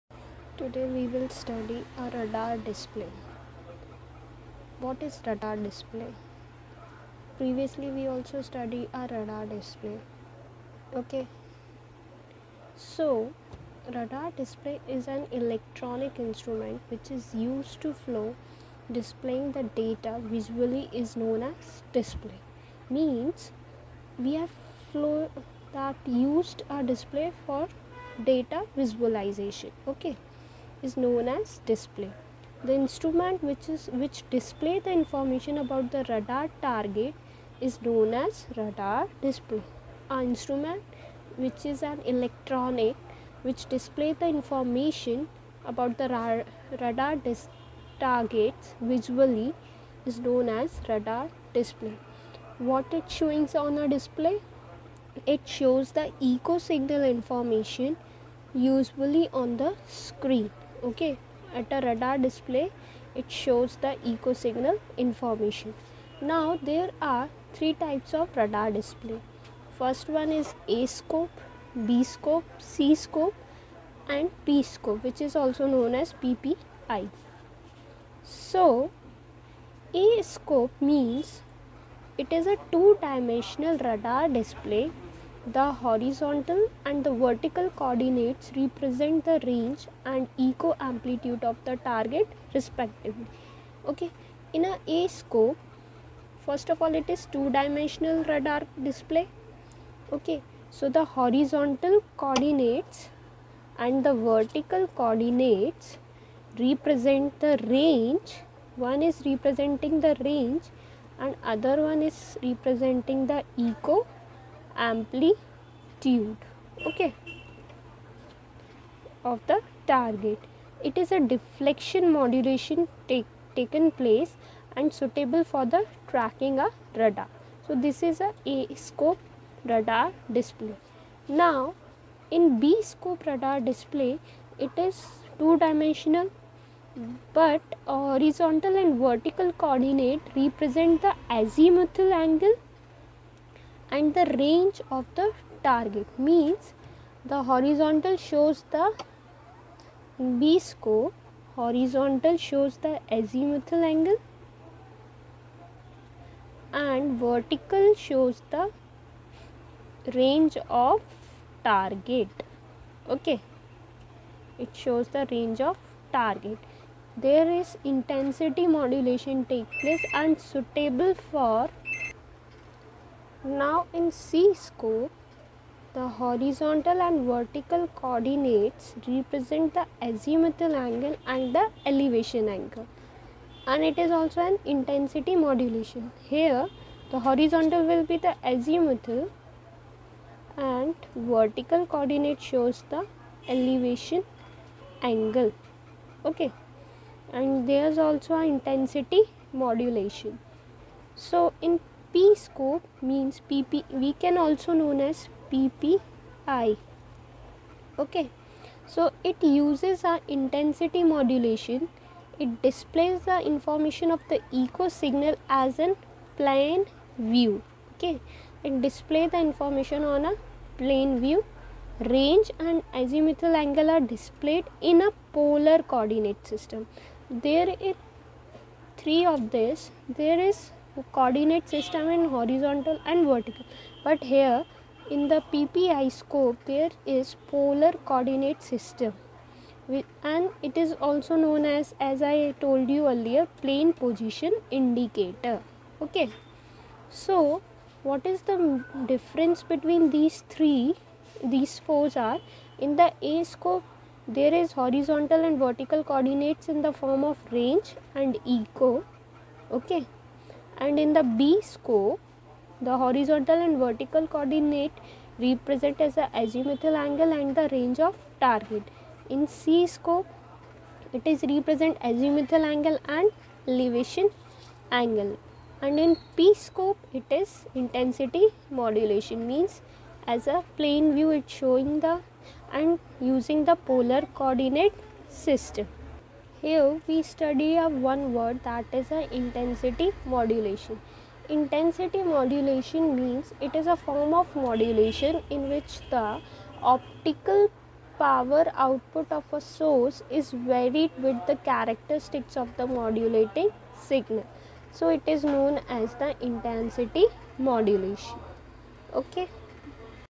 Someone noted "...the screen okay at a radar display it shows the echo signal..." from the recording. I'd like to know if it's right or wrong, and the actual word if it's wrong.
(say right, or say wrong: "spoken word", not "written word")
right.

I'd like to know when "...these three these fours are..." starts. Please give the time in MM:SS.
04:10.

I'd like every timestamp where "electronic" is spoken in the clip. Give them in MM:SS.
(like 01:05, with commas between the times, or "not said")
00:15, 00:42.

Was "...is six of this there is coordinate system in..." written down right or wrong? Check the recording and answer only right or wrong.
wrong.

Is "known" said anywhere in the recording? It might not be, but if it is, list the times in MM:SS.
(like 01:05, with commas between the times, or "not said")
00:21, 00:30, 00:37, 00:50, 01:15, 03:24, 04:01, 05:05.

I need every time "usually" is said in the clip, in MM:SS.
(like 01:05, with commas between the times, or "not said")
00:58.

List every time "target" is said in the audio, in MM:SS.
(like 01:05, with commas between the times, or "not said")
00:36, 00:47, 01:31, 01:59, 02:25, 02:41, 02:46, 04:28.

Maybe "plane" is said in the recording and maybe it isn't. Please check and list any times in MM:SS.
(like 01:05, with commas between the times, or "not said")
03:36, 03:40, 04:03, 04:40.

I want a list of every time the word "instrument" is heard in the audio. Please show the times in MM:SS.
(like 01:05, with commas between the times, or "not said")
00:16, 00:32, 00:40.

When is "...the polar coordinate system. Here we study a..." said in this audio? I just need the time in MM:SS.
04:43.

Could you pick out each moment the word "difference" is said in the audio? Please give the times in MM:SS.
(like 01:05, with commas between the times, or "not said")
04:09.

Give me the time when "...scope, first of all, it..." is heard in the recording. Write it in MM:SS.
01:35.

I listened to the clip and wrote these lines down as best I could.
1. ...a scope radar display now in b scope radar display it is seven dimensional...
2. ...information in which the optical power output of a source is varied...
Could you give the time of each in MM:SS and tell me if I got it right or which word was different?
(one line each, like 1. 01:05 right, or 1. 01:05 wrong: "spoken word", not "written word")
1. 02:08 wrong: "two", not "seven"
2. 04:54 wrong: "modulation", not "information".